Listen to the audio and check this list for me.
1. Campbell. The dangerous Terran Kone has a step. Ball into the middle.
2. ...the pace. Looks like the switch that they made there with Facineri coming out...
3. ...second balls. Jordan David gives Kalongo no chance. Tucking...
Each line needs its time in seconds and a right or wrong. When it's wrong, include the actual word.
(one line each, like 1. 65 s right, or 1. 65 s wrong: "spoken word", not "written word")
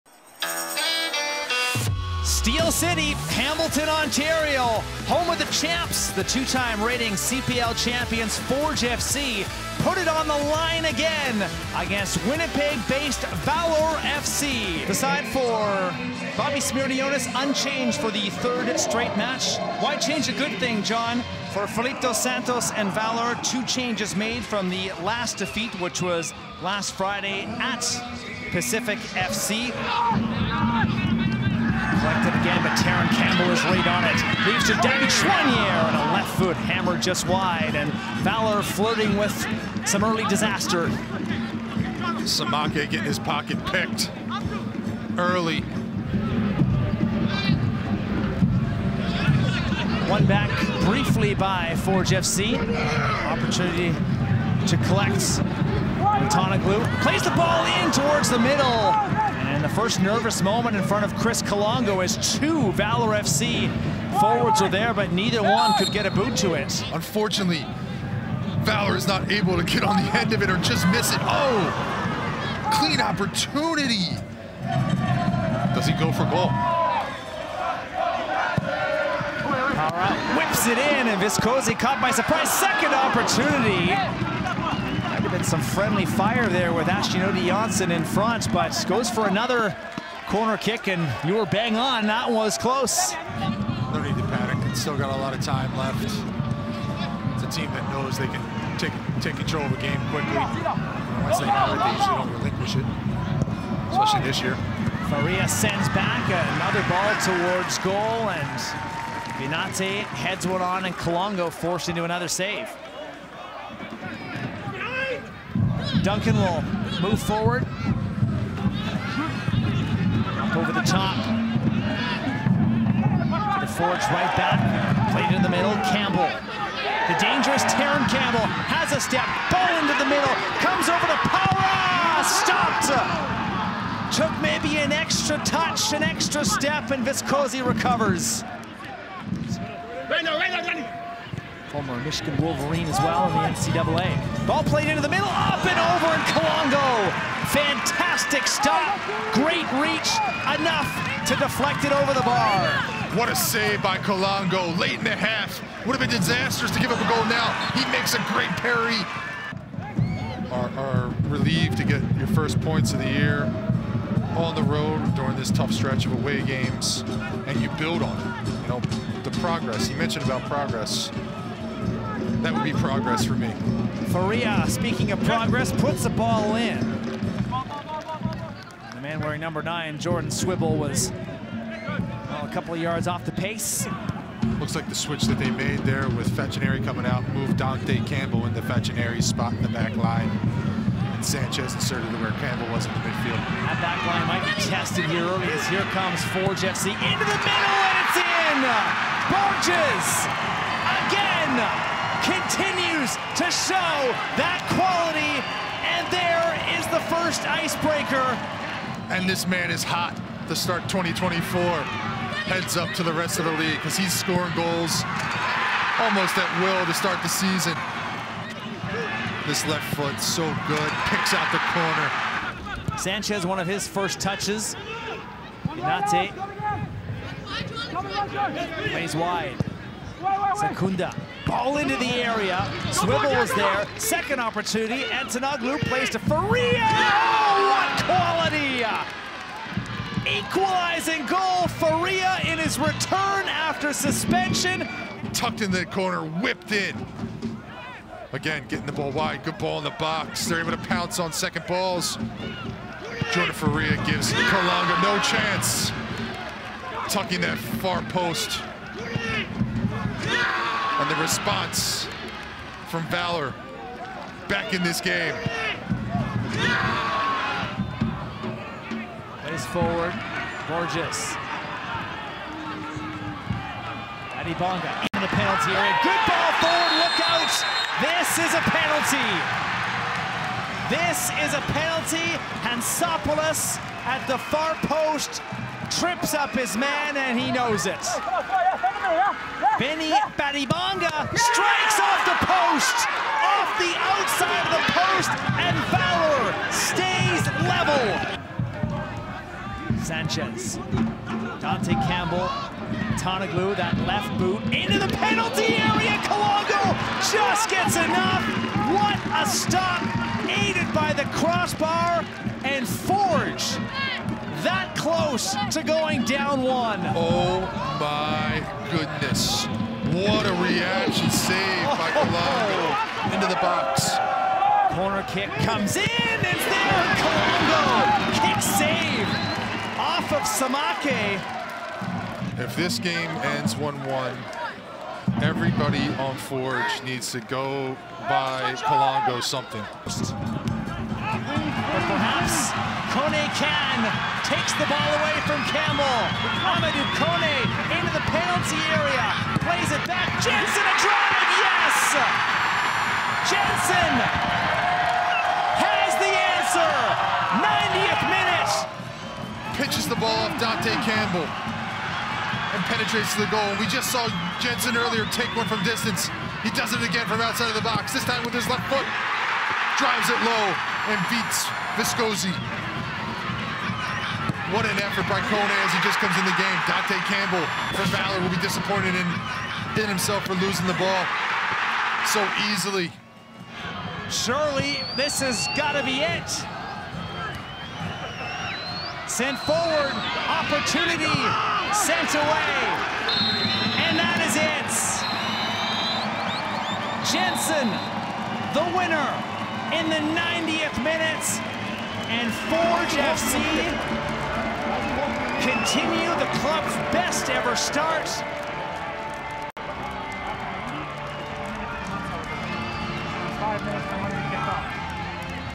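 1. 125 s wrong: "Campbell", not "Kone"
2. 183 s right
3. 251 s wrong: "Faria", not "David".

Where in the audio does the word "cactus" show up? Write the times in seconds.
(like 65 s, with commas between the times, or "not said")
not said.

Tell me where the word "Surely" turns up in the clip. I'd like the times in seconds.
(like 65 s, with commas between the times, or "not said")
384 s.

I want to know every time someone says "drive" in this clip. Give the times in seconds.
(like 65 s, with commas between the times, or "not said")
350 s, 369 s.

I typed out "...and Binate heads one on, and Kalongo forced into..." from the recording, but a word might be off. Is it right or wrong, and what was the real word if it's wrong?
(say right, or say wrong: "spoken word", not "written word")
right.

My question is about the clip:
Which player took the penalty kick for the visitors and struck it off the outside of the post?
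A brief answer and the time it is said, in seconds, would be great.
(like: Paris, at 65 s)
Benny Badibanga, at 289 s.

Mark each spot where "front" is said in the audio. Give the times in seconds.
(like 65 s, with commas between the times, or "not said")
60 s, 88 s.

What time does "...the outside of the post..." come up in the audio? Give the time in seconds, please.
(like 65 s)
293 s.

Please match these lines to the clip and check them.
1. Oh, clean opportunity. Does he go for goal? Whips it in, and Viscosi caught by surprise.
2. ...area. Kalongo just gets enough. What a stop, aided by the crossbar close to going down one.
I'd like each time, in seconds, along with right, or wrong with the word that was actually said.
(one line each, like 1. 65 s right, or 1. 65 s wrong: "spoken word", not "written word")
1. 71 s right
2. 305 s right.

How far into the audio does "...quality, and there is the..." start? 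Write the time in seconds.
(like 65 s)
204 s.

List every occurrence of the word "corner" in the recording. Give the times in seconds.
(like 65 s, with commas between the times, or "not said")
90 s, 221 s, 245 s, 324 s.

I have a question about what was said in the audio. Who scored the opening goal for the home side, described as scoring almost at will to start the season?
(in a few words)
Borges.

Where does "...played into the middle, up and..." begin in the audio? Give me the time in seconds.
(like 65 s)
144 s.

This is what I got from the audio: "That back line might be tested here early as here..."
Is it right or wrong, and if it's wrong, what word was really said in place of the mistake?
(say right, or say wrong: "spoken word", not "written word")
right.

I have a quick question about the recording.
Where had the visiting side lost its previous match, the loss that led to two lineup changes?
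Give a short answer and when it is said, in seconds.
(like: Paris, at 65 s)
Pacific FC, at 28 s.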